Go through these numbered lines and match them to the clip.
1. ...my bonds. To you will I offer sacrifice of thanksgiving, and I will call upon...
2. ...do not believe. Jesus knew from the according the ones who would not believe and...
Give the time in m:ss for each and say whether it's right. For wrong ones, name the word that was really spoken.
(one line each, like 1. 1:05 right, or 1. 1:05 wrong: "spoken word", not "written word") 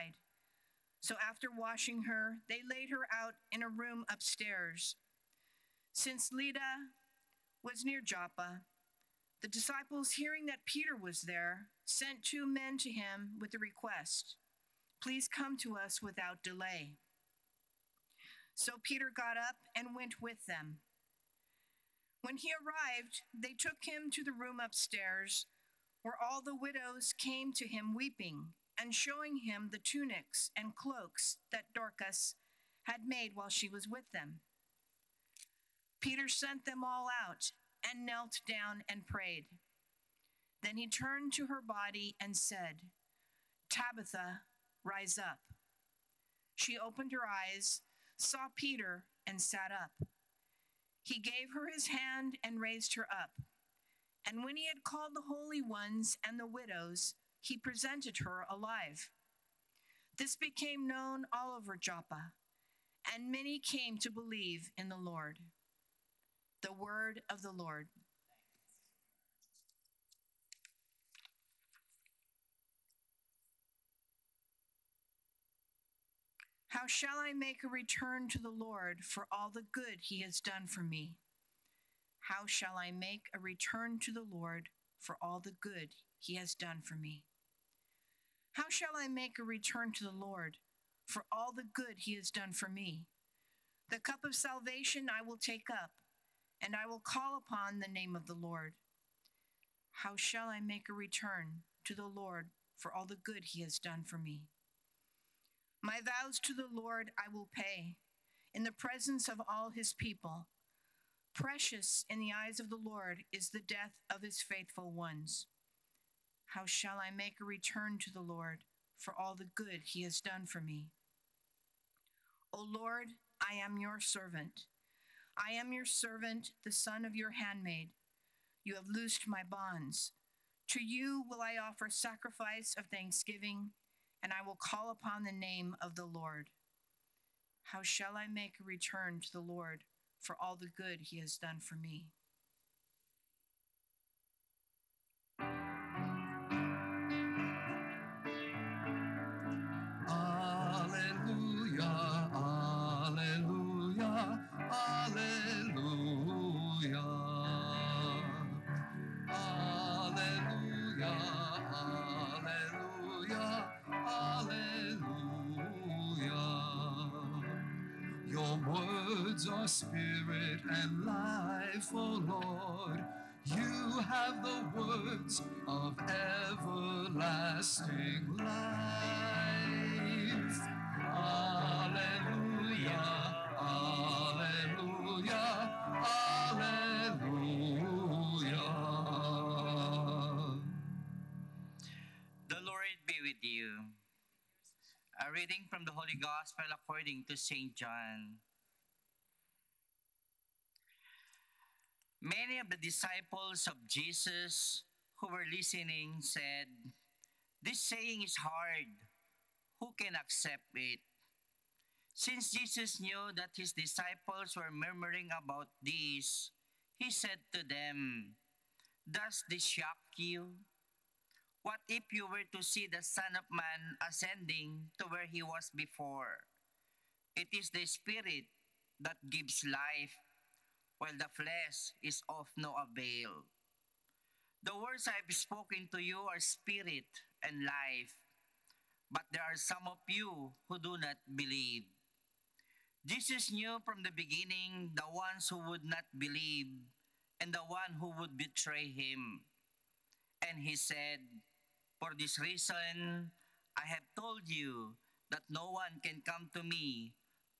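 1. 2:09 right
2. 4:00 wrong: "beginning", not "according".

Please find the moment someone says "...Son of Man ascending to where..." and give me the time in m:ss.
3:43.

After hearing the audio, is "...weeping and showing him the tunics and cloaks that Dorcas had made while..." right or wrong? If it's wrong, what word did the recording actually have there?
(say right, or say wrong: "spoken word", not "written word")
right.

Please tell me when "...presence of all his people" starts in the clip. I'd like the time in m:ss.
1:48.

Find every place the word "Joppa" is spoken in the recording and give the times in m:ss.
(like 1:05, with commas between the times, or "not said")
0:08, 1:01.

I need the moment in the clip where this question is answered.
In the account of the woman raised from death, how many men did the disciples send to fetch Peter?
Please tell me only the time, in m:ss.
0:12.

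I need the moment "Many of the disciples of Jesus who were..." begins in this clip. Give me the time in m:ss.
3:22.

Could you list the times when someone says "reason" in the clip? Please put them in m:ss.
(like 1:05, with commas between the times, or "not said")
4:12.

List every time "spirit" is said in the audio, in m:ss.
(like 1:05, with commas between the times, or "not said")
2:49, 3:47, 3:56.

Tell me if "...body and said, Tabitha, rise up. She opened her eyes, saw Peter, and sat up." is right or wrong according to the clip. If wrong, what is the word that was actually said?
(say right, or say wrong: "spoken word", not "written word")
right.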